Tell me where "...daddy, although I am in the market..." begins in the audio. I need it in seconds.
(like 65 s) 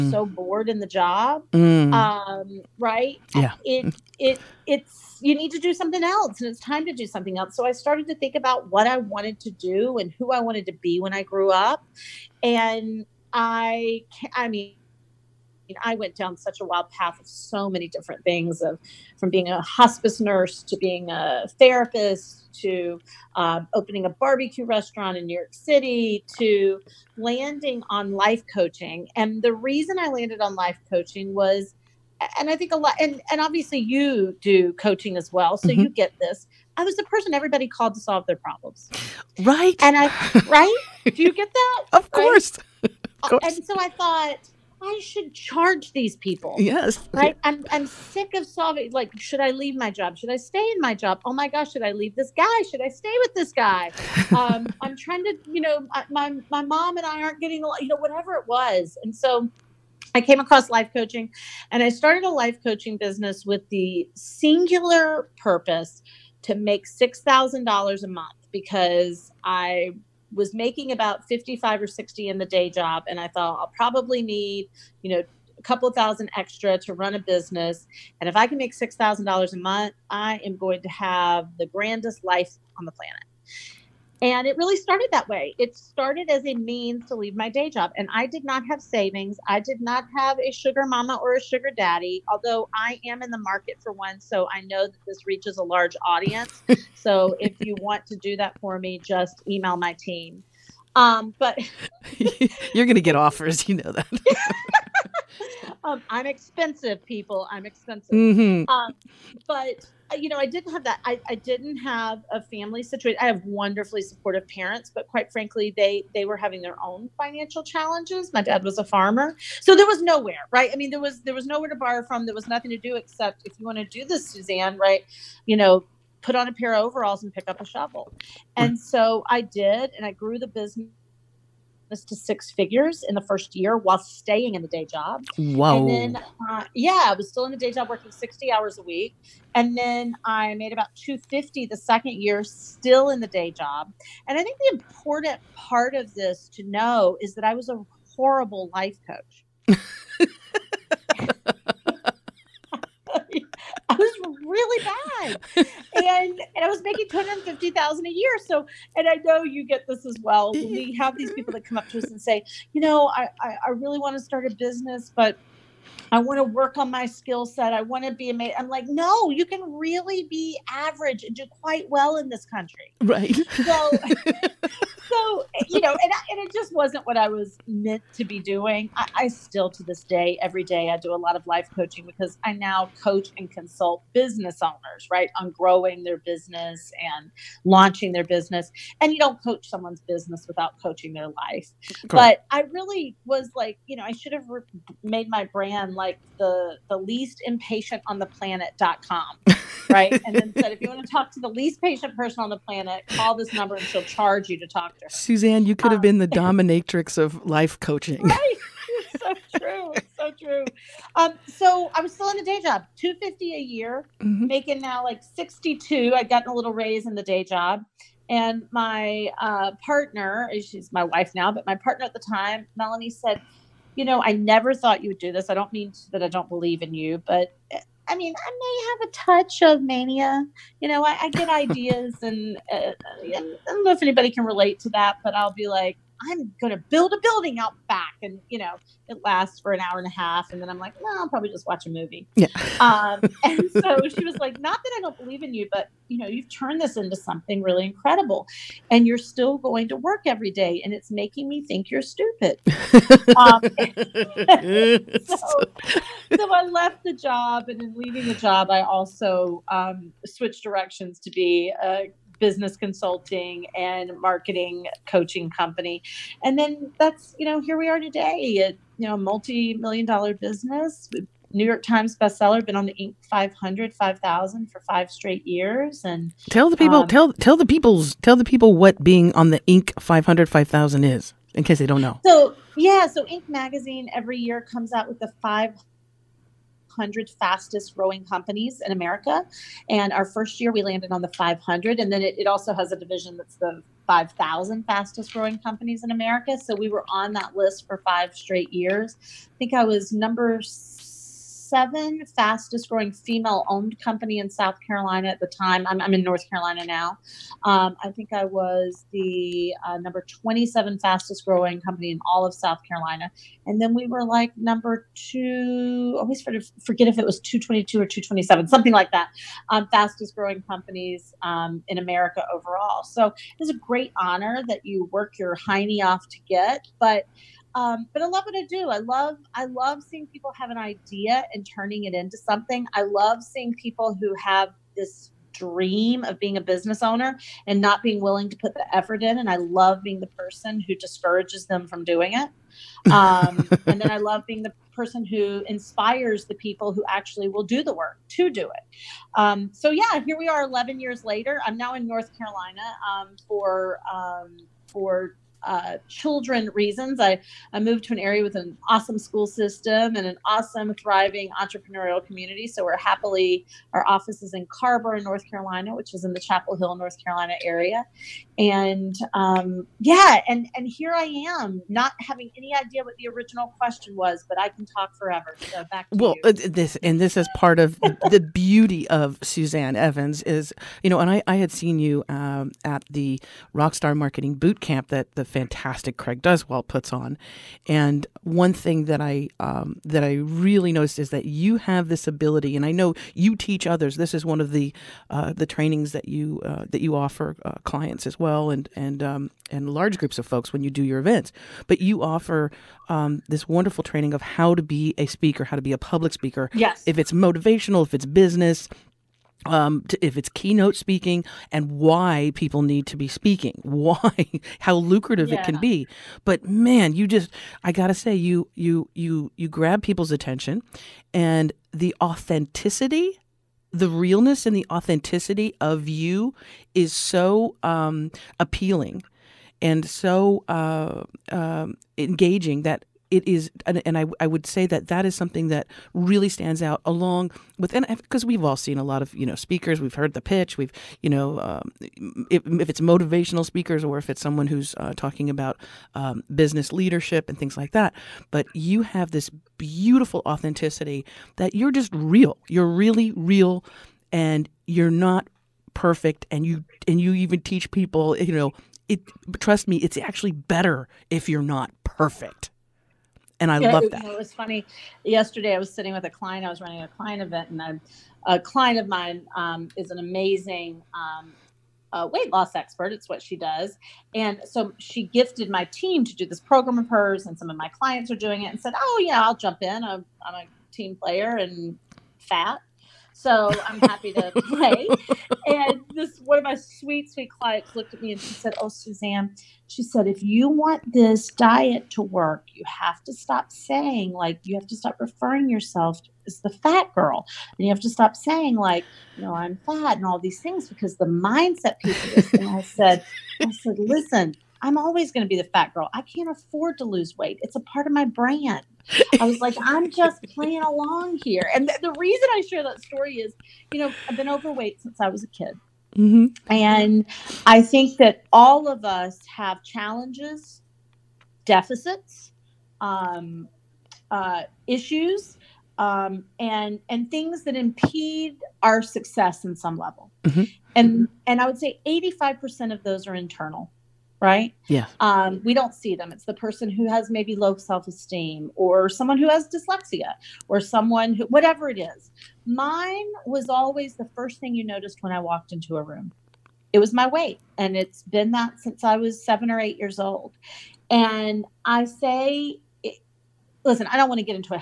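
91 s.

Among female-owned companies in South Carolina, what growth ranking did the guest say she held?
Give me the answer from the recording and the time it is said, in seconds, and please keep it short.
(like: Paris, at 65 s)
7, at 300 s.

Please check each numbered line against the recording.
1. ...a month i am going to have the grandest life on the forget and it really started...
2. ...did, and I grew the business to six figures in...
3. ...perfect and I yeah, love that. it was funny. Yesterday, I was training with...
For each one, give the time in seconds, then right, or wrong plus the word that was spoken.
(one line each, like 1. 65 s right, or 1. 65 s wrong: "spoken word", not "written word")
1. 79 s wrong: "planet", not "forget"
2. 129 s right
3. 462 s wrong: "sitting", not "training".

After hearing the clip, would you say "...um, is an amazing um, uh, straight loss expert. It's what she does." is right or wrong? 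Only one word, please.
wrong.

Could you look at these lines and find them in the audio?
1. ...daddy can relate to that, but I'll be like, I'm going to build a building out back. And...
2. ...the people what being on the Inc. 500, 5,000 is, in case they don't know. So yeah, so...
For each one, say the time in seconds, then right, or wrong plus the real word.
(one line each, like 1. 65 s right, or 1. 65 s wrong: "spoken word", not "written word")
1. 234 s wrong: "anybody", not "daddy"
2. 278 s right.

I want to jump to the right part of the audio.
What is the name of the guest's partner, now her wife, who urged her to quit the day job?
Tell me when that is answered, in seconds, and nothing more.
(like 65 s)
222 s.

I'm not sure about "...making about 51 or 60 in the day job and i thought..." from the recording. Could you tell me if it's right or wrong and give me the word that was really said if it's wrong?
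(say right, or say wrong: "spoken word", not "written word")
wrong: "55", not "51".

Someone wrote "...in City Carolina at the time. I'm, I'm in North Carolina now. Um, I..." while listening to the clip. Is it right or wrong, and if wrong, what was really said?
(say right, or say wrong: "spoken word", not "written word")
wrong: "South", not "City".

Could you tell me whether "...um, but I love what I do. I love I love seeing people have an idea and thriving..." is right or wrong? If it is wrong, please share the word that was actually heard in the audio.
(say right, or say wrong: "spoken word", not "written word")
wrong: "turning", not "thriving".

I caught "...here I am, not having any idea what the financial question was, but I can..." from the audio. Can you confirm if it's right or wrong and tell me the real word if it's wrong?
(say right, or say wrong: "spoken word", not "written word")
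wrong: "original", not "financial".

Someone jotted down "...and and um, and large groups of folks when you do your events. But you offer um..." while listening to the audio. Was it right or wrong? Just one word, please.
right.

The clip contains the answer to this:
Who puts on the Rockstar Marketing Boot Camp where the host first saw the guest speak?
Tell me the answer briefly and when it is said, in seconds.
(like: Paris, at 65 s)
Craig Duswalt, at 386 s.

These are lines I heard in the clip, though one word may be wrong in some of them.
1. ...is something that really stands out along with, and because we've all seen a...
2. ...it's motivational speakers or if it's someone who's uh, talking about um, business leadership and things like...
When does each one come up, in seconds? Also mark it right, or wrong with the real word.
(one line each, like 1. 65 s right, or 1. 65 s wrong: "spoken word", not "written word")
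1. 435 s right
2. 442 s right.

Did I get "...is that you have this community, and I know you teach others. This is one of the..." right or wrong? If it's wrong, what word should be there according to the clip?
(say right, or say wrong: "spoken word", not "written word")
wrong: "ability", not "community".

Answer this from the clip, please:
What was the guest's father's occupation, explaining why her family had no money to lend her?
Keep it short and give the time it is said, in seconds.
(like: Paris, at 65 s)
farmer, at 118 s.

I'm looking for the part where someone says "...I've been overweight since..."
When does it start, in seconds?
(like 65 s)
514 s.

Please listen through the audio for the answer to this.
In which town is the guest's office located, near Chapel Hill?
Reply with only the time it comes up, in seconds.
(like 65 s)
364 s.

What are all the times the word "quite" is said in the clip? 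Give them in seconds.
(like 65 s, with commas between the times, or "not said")
115 s, 171 s.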